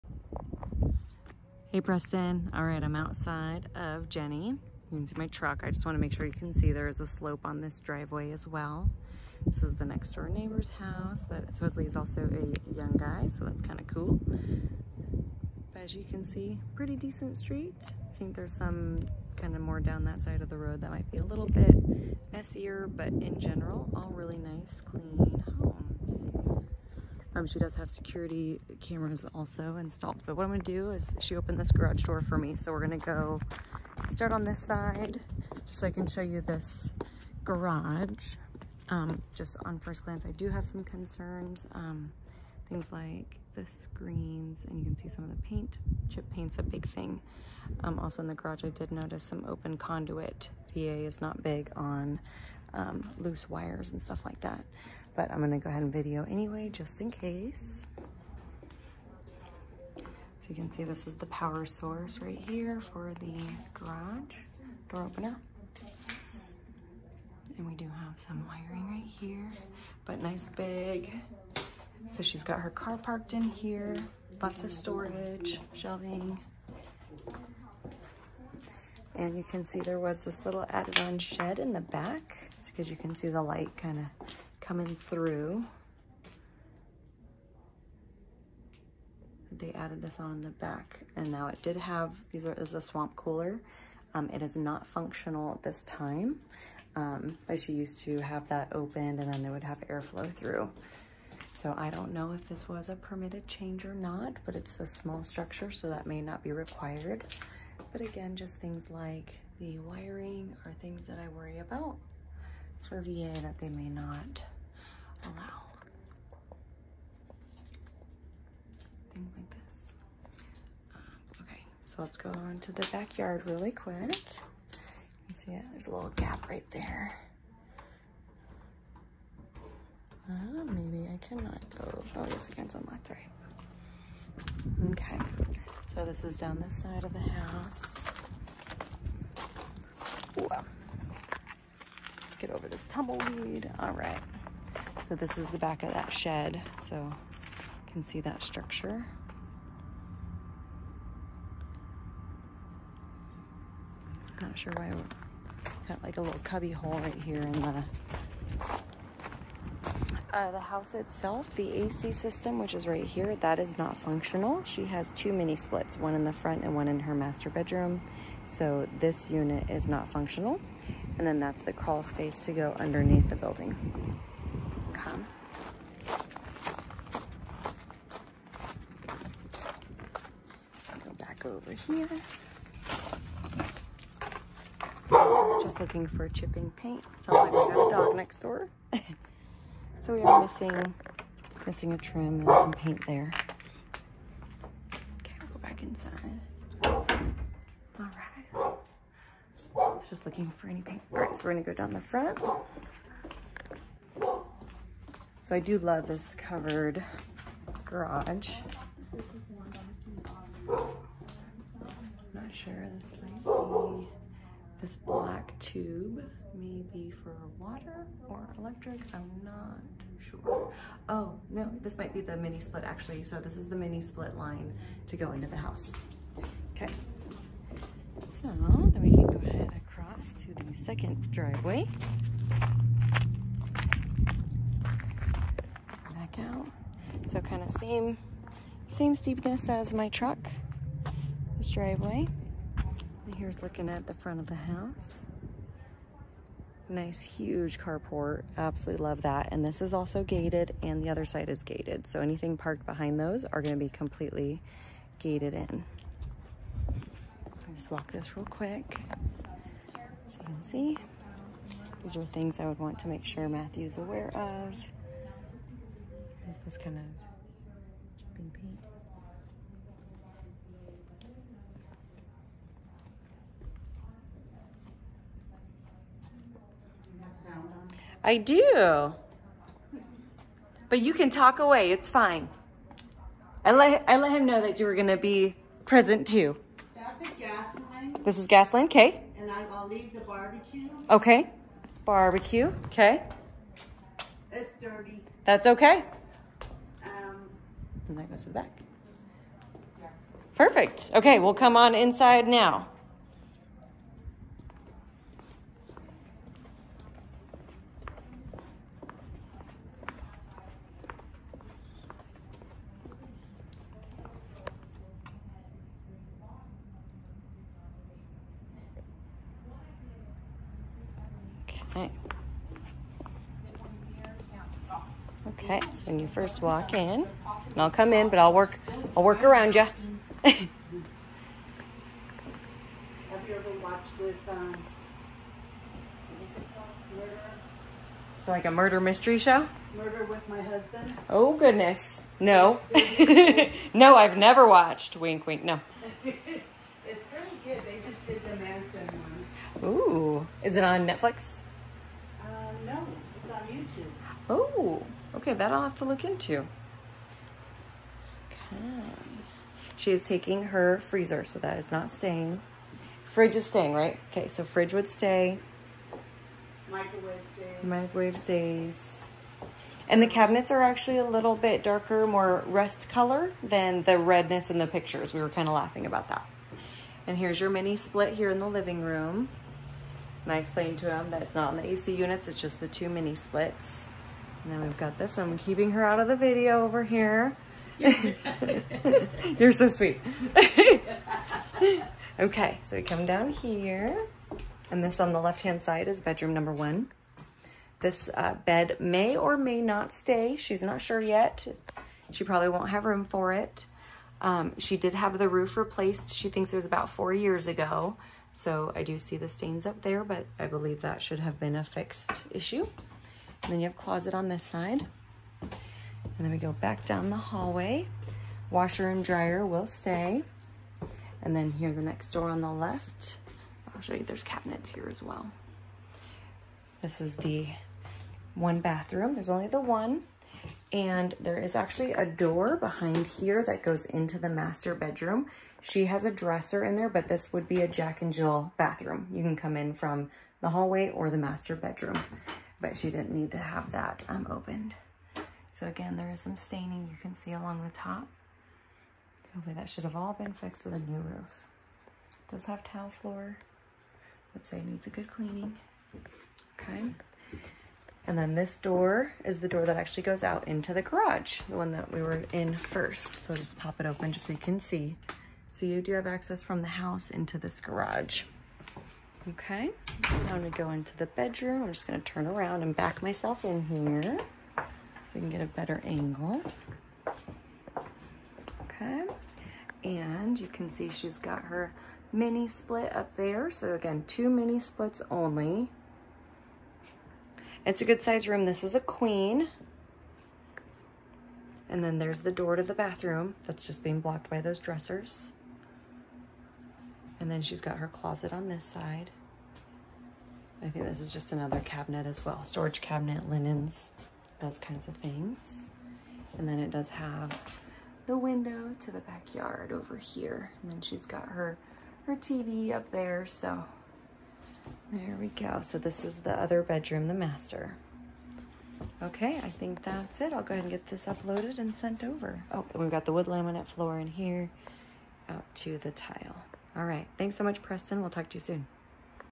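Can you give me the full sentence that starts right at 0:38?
Um, just on first glance, I do have some concerns.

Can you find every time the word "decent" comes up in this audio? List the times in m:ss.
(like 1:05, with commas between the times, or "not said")
0:16.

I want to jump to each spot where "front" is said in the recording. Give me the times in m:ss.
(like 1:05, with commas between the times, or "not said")
2:46, 3:22, 4:04.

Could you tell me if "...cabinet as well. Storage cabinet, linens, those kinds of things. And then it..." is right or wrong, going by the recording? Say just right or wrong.
right.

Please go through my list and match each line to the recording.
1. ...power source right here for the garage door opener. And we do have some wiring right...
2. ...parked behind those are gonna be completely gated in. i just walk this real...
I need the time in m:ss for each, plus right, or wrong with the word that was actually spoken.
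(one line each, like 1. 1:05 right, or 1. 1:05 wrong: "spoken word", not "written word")
1. 1:01 right
2. 4:12 right.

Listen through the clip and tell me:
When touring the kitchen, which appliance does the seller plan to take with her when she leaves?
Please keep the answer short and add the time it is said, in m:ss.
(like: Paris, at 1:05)
Freezer, at 6:00.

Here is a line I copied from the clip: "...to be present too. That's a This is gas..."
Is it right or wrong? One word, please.
right.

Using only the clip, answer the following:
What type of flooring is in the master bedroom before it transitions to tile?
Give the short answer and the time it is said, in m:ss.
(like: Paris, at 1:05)
Wood laminate, at 8:43.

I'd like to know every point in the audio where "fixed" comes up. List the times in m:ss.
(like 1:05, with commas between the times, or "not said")
6:51, 7:30.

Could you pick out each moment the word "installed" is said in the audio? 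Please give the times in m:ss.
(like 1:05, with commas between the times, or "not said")
0:29.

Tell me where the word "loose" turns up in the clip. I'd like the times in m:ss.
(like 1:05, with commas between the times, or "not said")
0:53.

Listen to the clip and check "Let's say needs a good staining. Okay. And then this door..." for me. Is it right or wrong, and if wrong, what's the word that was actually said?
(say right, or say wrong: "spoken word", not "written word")
wrong: "cleaning", not "staining".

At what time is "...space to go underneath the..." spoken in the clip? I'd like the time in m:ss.
2:52.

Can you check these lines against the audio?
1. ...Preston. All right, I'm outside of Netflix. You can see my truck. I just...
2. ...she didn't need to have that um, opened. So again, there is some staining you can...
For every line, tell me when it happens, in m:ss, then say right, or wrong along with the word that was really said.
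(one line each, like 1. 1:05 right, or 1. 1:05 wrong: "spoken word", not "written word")
1. 0:01 wrong: "Jennie", not "Netflix"
2. 7:22 right.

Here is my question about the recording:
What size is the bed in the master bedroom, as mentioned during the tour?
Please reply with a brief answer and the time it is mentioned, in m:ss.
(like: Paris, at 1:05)
Queen, at 8:08.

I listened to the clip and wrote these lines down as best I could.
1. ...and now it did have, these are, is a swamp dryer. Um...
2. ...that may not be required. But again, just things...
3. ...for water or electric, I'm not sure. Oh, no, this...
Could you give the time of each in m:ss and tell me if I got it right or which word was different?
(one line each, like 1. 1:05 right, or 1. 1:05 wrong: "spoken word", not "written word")
1. 1:31 wrong: "cooler", not "dryer"
2. 1:45 right
3. 3:37 right.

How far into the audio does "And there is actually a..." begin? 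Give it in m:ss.
7:10.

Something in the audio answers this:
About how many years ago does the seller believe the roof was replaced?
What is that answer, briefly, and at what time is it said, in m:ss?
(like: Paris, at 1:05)
4 years, at 6:47.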